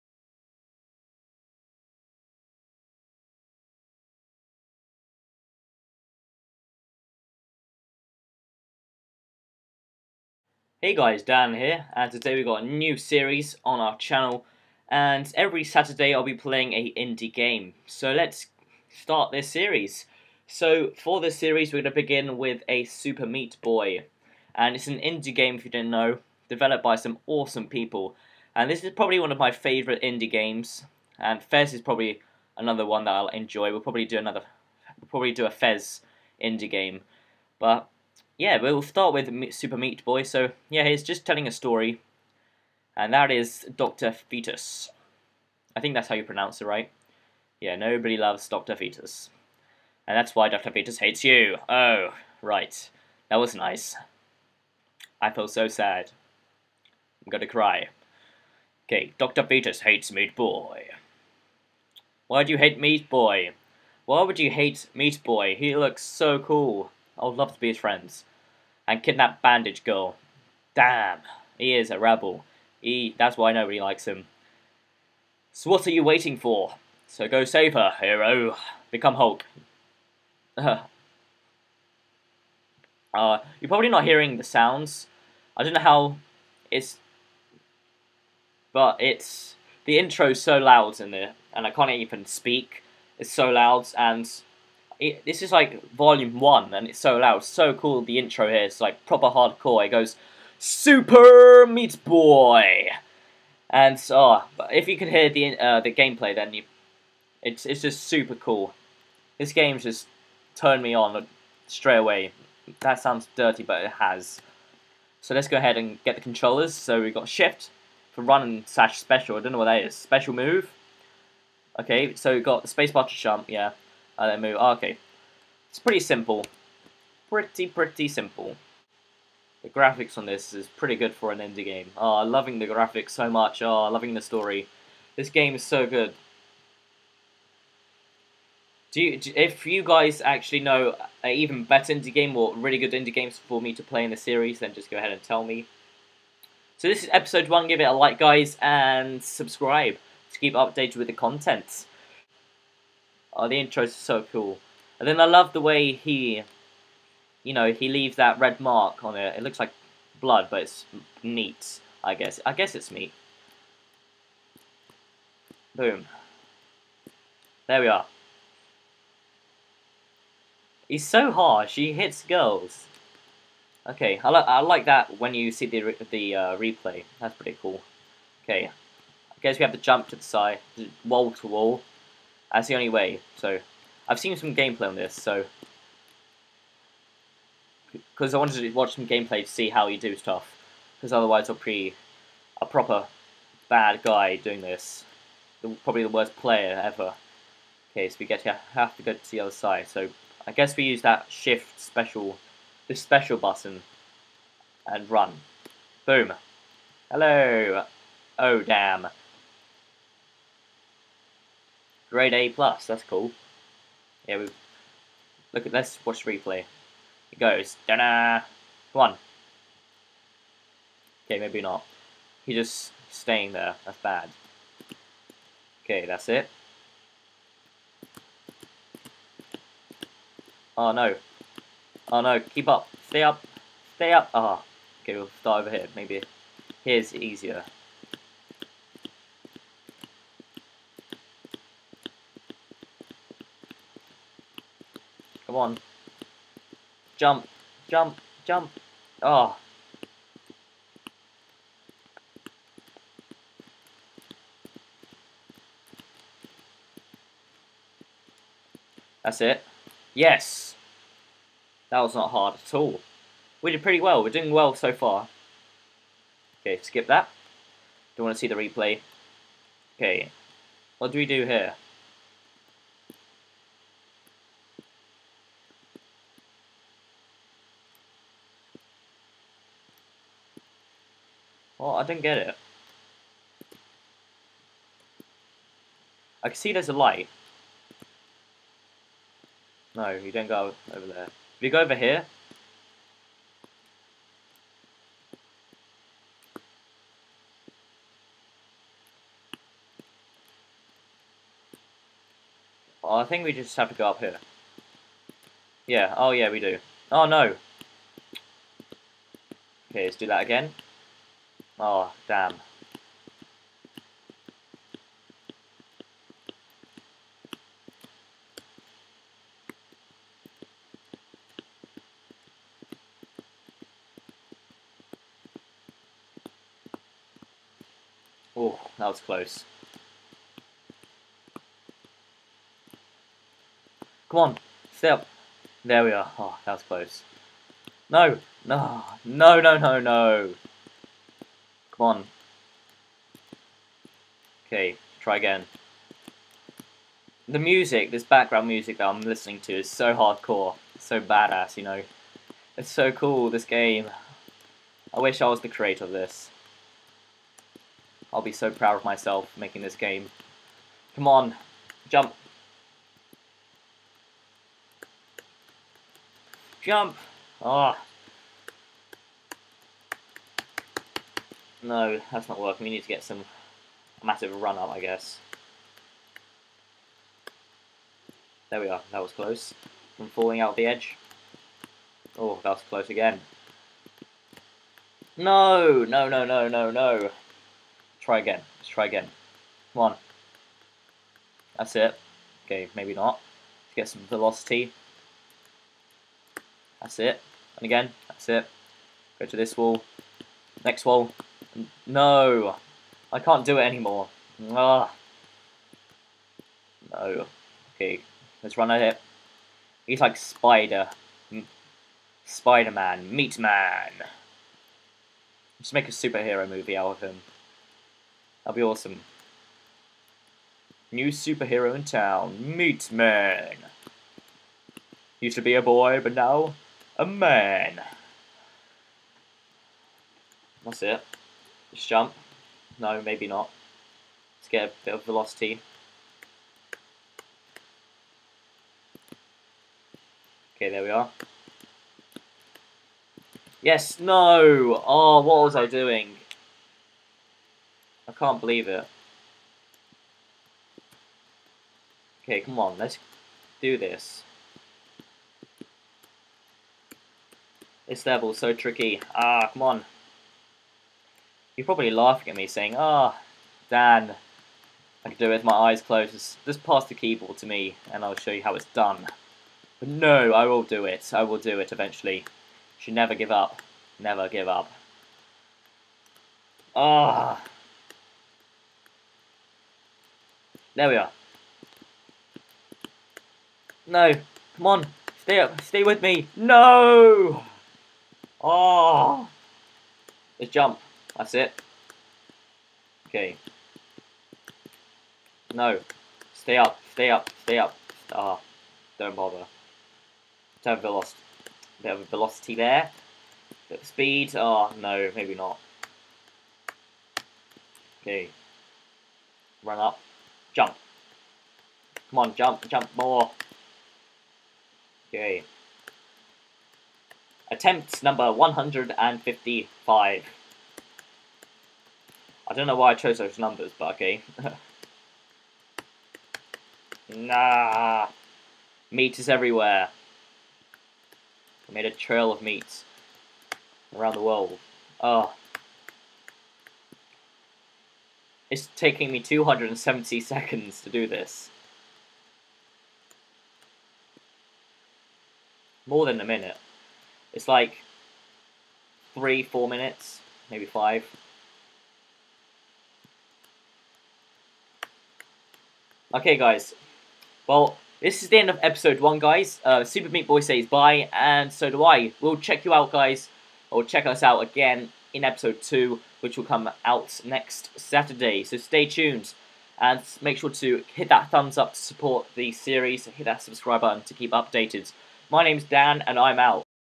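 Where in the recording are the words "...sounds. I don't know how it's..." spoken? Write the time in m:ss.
1:24.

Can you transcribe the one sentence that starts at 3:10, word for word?
Because otherwise I'll be a proper bad guy doing this.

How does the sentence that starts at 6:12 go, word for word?
We need to get some massive run up, I guess.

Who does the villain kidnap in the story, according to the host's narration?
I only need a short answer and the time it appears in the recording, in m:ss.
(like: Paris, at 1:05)
Bandage Girl, at 1:09.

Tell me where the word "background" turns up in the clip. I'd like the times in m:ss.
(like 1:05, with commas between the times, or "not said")
5:48.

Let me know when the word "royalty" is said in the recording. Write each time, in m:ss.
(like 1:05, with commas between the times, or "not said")
not said.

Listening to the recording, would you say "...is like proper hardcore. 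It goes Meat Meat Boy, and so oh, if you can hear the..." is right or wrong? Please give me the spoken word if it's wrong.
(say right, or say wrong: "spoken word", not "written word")
wrong: "Super", not "Meat".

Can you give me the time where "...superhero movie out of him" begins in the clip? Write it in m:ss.
6:56.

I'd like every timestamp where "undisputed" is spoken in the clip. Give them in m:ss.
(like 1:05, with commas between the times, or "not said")
not said.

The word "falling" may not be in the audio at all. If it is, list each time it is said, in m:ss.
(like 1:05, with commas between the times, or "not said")
6:20.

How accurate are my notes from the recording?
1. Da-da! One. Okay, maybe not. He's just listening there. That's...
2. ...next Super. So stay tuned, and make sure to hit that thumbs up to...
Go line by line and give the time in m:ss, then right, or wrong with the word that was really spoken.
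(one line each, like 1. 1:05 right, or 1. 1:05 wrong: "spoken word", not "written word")
1. 3:37 wrong: "staying", not "listening"
2. 9:27 wrong: "Saturday", not "Super".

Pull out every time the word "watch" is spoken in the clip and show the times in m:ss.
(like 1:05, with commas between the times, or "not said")
3:08, 3:36.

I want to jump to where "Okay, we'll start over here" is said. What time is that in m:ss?
3:55.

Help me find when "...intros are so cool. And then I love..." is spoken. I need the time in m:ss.
2:33.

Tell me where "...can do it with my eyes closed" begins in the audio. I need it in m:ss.
7:45.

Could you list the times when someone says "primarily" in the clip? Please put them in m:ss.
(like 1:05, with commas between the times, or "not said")
not said.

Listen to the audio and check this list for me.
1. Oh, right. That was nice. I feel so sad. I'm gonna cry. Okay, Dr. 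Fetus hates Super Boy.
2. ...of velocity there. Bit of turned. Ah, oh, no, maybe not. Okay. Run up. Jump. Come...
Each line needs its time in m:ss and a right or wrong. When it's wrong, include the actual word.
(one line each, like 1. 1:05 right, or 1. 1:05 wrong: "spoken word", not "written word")
1. 0:51 wrong: "Meat", not "Super"
2. 8:22 wrong: "speed", not "turned".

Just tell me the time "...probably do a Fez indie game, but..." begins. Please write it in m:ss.
0:35.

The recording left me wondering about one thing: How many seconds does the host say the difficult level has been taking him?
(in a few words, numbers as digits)
270.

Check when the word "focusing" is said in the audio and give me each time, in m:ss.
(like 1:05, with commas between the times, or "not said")
not said.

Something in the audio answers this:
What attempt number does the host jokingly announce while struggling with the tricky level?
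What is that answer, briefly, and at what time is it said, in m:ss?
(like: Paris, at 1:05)
155, at 8:38.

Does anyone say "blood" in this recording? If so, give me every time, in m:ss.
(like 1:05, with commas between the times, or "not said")
2:40.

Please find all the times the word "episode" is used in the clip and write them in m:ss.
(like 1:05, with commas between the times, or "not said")
2:27, 9:18, 9:25.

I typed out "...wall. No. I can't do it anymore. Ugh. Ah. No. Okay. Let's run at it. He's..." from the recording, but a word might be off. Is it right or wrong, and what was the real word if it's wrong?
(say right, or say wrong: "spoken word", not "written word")
right.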